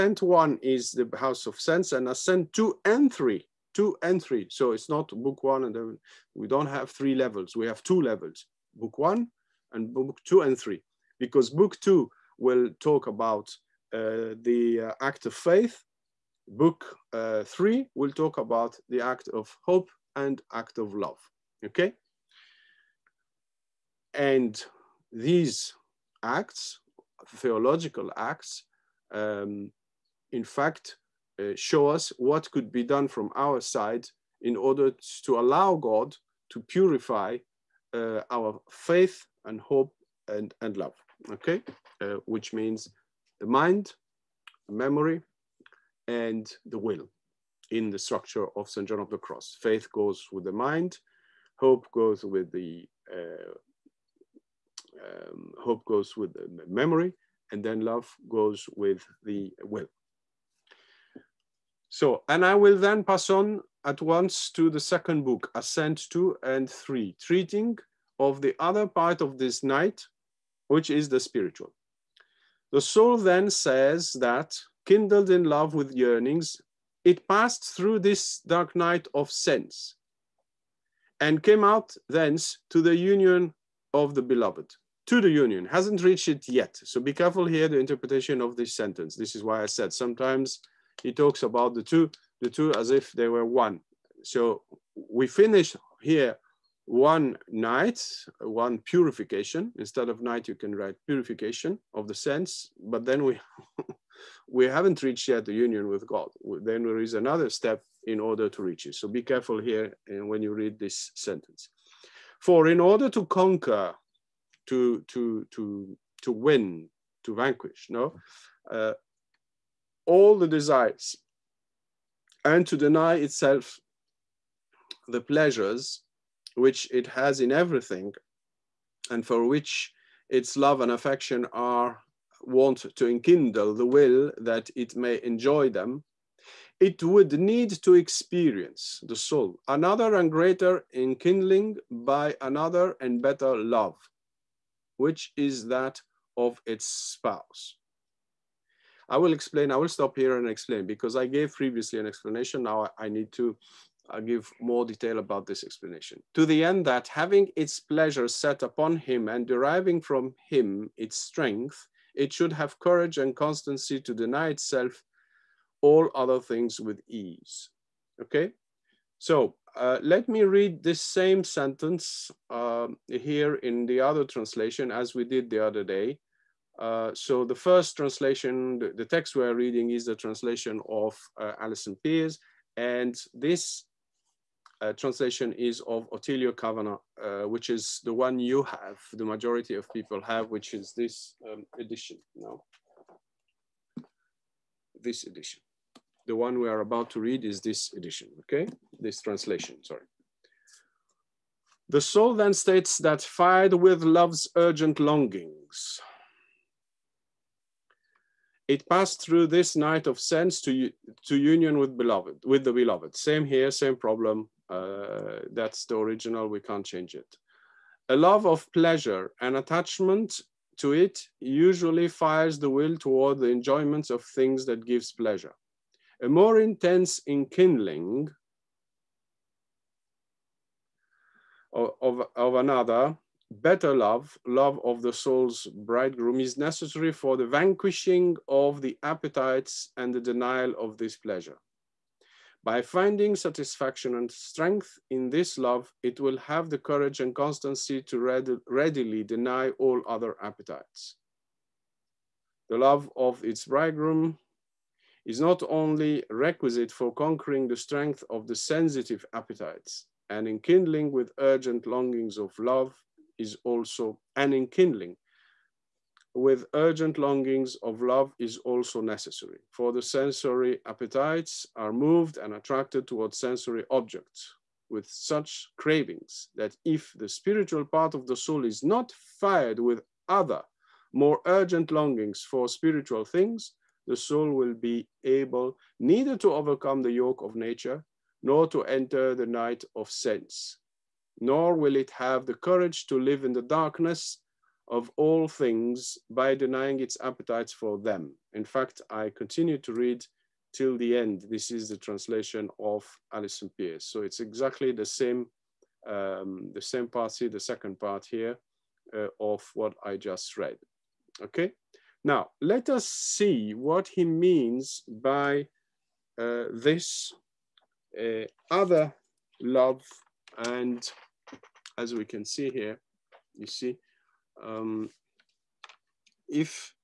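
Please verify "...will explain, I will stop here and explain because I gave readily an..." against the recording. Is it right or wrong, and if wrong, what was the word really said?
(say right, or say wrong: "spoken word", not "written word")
wrong: "previously", not "readily".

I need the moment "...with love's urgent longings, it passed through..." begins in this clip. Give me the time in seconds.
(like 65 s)
203 s.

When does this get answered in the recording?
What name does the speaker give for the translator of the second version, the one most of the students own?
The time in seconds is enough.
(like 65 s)
186 s.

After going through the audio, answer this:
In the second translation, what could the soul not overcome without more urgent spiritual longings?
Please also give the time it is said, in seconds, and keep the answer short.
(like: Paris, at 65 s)
The yoke of nature, at 287 s.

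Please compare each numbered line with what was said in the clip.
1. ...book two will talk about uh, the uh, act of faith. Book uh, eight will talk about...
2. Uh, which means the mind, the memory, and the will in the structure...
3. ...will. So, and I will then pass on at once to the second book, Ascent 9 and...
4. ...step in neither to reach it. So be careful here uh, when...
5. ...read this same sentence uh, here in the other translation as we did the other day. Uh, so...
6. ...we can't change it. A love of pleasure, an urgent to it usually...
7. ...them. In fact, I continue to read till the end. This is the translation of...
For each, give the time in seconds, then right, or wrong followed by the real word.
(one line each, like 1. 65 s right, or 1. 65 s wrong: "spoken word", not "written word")
1. 11 s wrong: "three", not "eight"
2. 42 s right
3. 59 s wrong: "2", not "9"
4. 107 s wrong: "order", not "neither"
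5. 170 s right
6. 216 s wrong: "attachment", not "urgent"
7. 297 s right.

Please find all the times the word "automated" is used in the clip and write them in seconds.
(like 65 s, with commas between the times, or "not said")
not said.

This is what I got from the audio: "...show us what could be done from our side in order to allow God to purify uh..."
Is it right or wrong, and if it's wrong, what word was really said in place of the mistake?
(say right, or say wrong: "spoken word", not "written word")
right.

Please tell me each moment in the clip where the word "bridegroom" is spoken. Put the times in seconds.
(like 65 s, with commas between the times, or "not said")
235 s, 253 s.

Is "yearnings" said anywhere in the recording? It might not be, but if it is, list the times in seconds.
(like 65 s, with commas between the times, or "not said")
75 s.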